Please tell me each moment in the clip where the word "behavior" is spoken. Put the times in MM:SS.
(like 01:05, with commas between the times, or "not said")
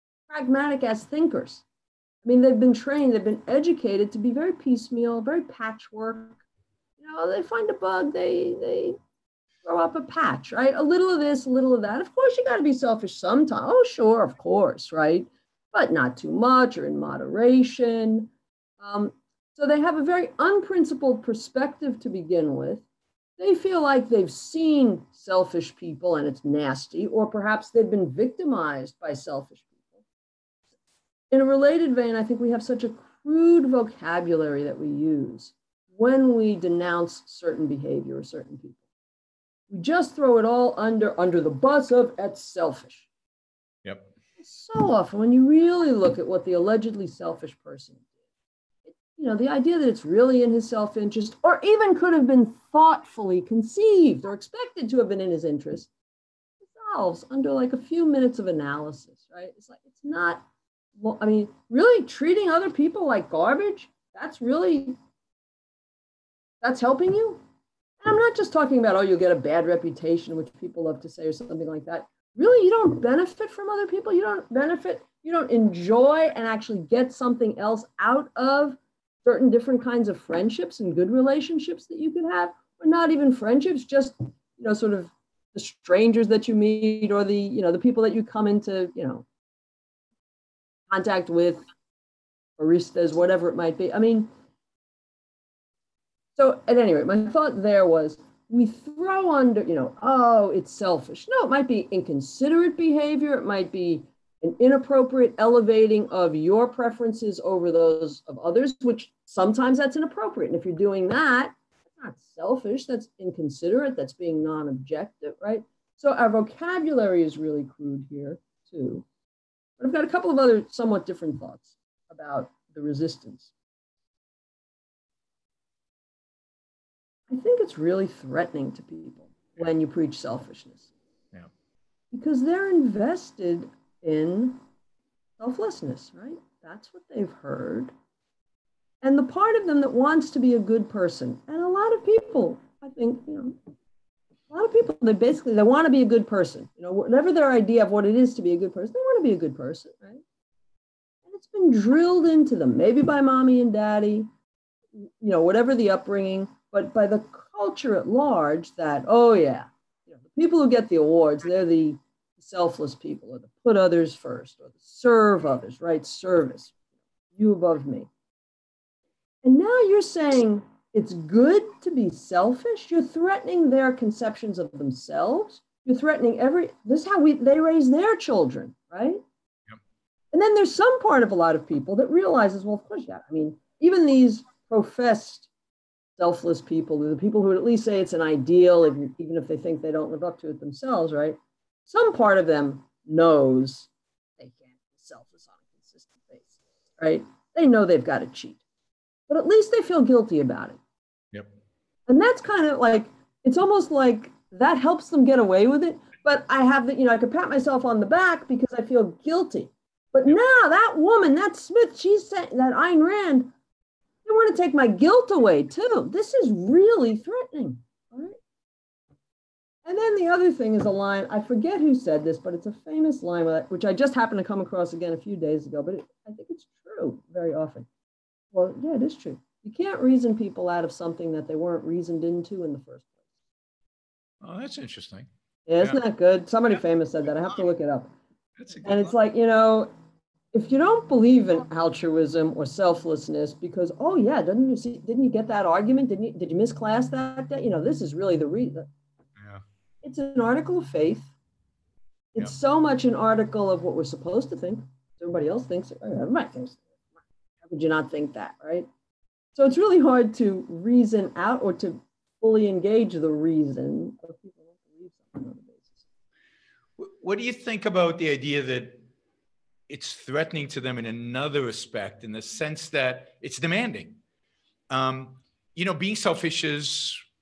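00:37, 01:42.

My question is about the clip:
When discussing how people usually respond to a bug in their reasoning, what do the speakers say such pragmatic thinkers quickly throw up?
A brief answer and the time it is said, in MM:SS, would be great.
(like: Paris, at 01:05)
A patch, at 00:09.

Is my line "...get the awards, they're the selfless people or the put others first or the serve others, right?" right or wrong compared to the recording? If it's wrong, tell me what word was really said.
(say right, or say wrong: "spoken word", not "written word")
right.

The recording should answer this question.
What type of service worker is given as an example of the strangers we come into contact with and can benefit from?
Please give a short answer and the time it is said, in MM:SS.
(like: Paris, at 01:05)
Baristas, at 01:32.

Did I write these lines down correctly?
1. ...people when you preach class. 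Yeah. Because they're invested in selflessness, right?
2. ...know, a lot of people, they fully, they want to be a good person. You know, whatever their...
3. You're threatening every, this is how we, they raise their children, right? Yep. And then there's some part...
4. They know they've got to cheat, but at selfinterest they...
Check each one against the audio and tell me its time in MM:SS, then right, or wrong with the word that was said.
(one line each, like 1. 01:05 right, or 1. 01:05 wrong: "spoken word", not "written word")
1. 02:08 wrong: "selfishness", not "class"
2. 02:23 wrong: "basically", not "fully"
3. 02:55 right
4. 03:17 wrong: "least", not "selfinterest".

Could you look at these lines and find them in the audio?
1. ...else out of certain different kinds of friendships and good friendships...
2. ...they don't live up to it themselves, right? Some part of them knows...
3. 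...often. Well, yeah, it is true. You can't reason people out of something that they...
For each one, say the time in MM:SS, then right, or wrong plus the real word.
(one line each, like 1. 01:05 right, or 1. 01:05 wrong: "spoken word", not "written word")
1. 01:17 wrong: "relationships", not "friendships"
2. 03:09 right
3. 03:47 right.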